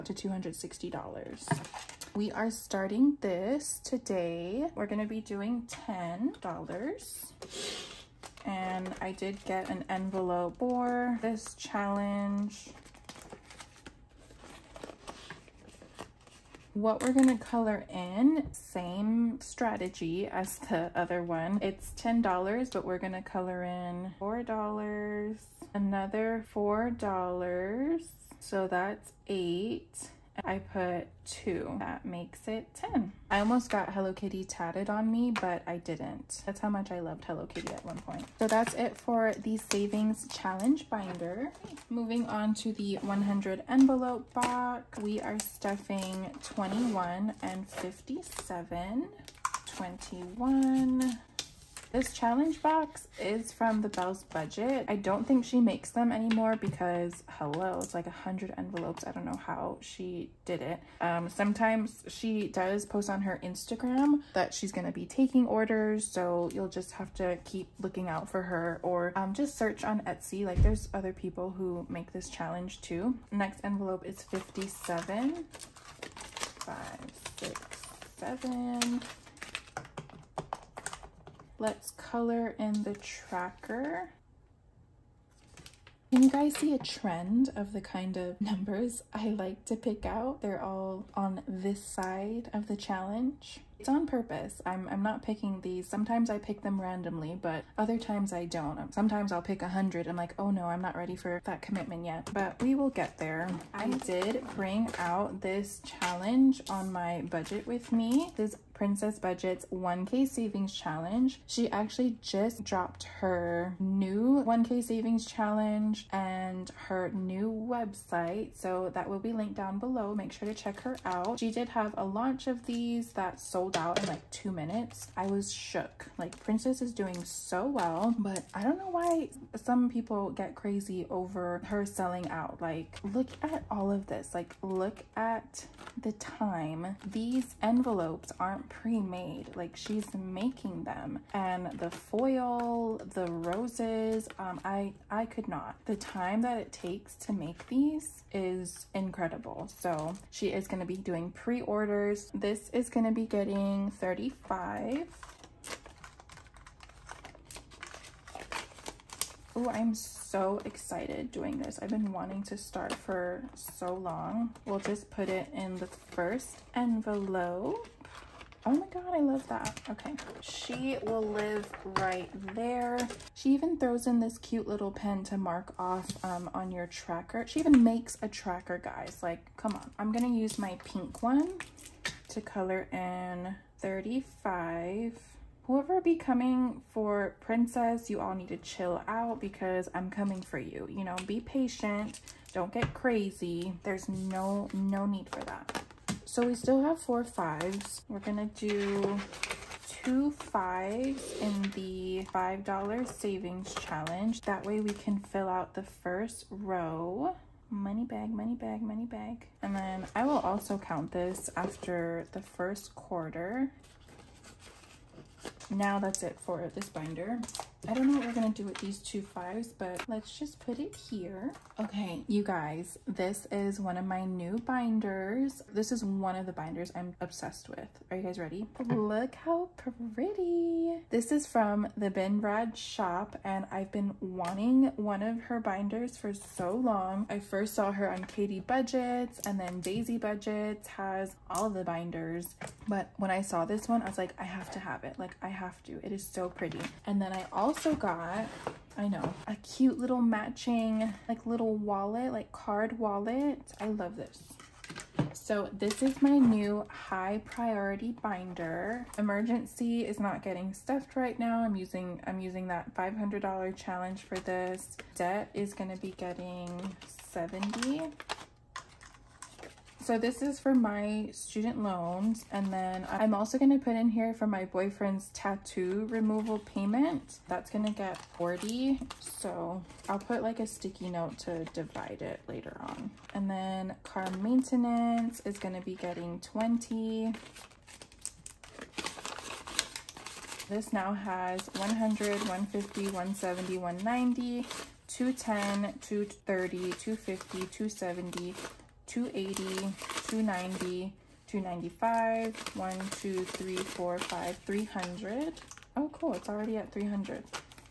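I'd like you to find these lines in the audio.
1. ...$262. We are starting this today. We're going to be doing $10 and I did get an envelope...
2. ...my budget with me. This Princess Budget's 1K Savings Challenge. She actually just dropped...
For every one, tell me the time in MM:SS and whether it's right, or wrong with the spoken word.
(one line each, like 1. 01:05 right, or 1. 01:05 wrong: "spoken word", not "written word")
1. 00:00 wrong: "260", not "262"
2. 01:46 right.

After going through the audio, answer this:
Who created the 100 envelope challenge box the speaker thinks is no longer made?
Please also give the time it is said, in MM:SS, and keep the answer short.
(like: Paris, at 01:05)
Belle's Budget, at 00:53.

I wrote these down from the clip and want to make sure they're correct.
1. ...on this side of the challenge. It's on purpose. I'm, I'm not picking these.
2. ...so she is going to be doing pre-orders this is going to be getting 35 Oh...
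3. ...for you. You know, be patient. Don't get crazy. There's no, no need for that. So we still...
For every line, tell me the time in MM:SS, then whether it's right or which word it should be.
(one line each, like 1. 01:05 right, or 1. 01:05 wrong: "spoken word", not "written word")
1. 01:31 right
2. 02:29 right
3. 03:10 right.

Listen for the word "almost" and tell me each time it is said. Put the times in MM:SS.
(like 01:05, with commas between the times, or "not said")
00:33.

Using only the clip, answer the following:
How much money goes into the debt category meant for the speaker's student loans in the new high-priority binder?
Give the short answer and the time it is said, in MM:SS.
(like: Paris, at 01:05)
$70, at 04:27.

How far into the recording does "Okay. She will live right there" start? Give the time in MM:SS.
02:49.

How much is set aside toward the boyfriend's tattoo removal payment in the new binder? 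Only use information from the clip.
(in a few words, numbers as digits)
$40.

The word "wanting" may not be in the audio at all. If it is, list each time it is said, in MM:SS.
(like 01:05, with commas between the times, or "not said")
02:42, 03:54.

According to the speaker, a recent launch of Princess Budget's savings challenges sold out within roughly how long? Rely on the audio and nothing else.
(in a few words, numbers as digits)
2 minutes.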